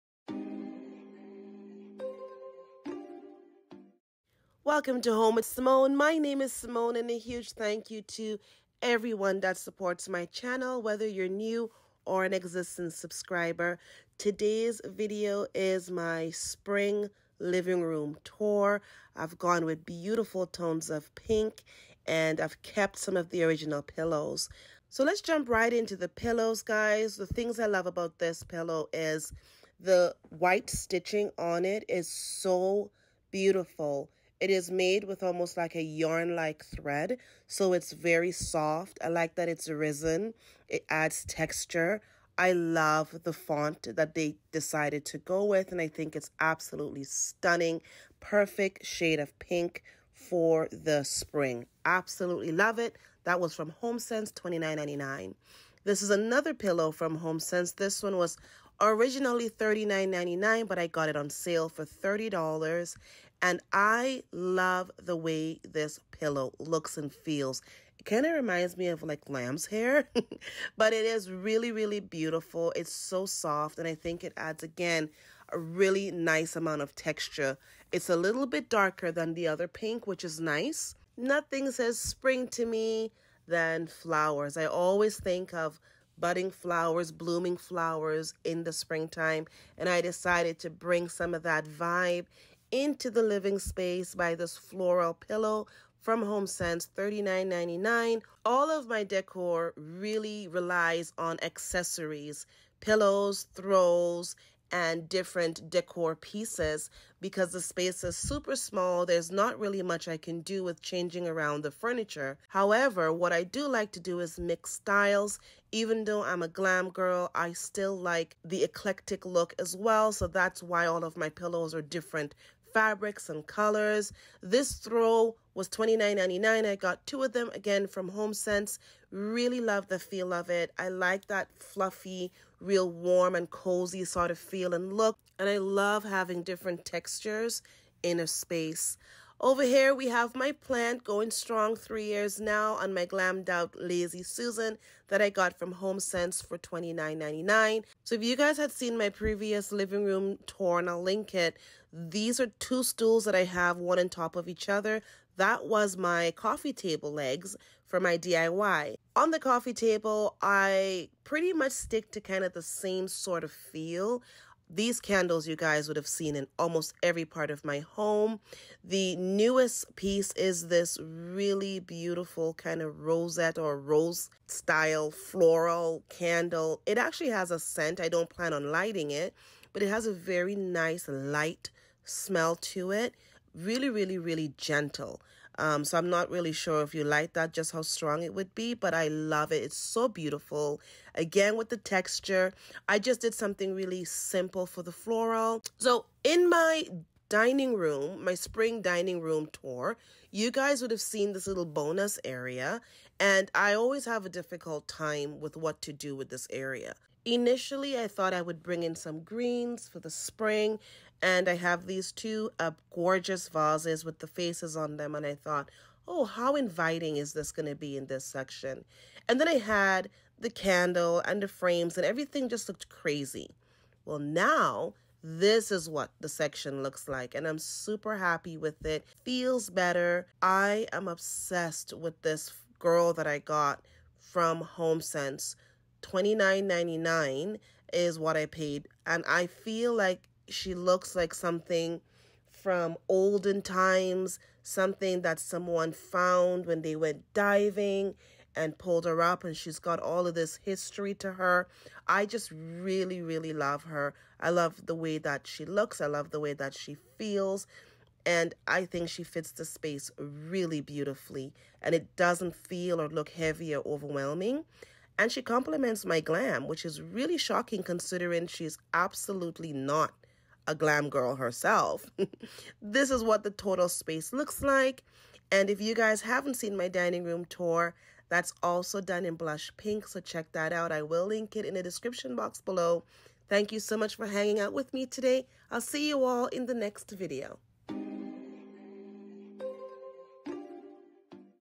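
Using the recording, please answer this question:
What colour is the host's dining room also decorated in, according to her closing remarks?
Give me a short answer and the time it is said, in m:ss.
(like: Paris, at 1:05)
Blush pink, at 4:39.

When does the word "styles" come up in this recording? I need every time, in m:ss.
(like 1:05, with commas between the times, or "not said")
1:54, 2:54.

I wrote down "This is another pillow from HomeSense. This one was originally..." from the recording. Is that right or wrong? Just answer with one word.
right.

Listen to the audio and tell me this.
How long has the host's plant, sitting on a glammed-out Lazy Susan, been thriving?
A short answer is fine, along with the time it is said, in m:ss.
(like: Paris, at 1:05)
3 years, at 2:21.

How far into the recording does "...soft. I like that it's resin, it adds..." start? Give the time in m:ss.
0:38.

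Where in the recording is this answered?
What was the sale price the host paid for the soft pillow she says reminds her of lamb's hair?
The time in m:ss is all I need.
1:01.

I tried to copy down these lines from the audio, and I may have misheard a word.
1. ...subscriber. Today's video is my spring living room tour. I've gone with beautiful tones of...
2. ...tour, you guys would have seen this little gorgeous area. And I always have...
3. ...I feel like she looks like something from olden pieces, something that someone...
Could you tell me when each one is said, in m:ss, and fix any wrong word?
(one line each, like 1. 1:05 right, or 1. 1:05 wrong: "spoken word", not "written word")
1. 0:12 right
2. 3:19 wrong: "bonus", not "gorgeous"
3. 3:59 wrong: "times", not "pieces".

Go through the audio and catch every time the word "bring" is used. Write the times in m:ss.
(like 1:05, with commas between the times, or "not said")
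1:30, 3:28.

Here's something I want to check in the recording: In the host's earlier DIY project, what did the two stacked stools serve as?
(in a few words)
Coffee table legs.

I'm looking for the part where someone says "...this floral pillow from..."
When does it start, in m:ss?
1:34.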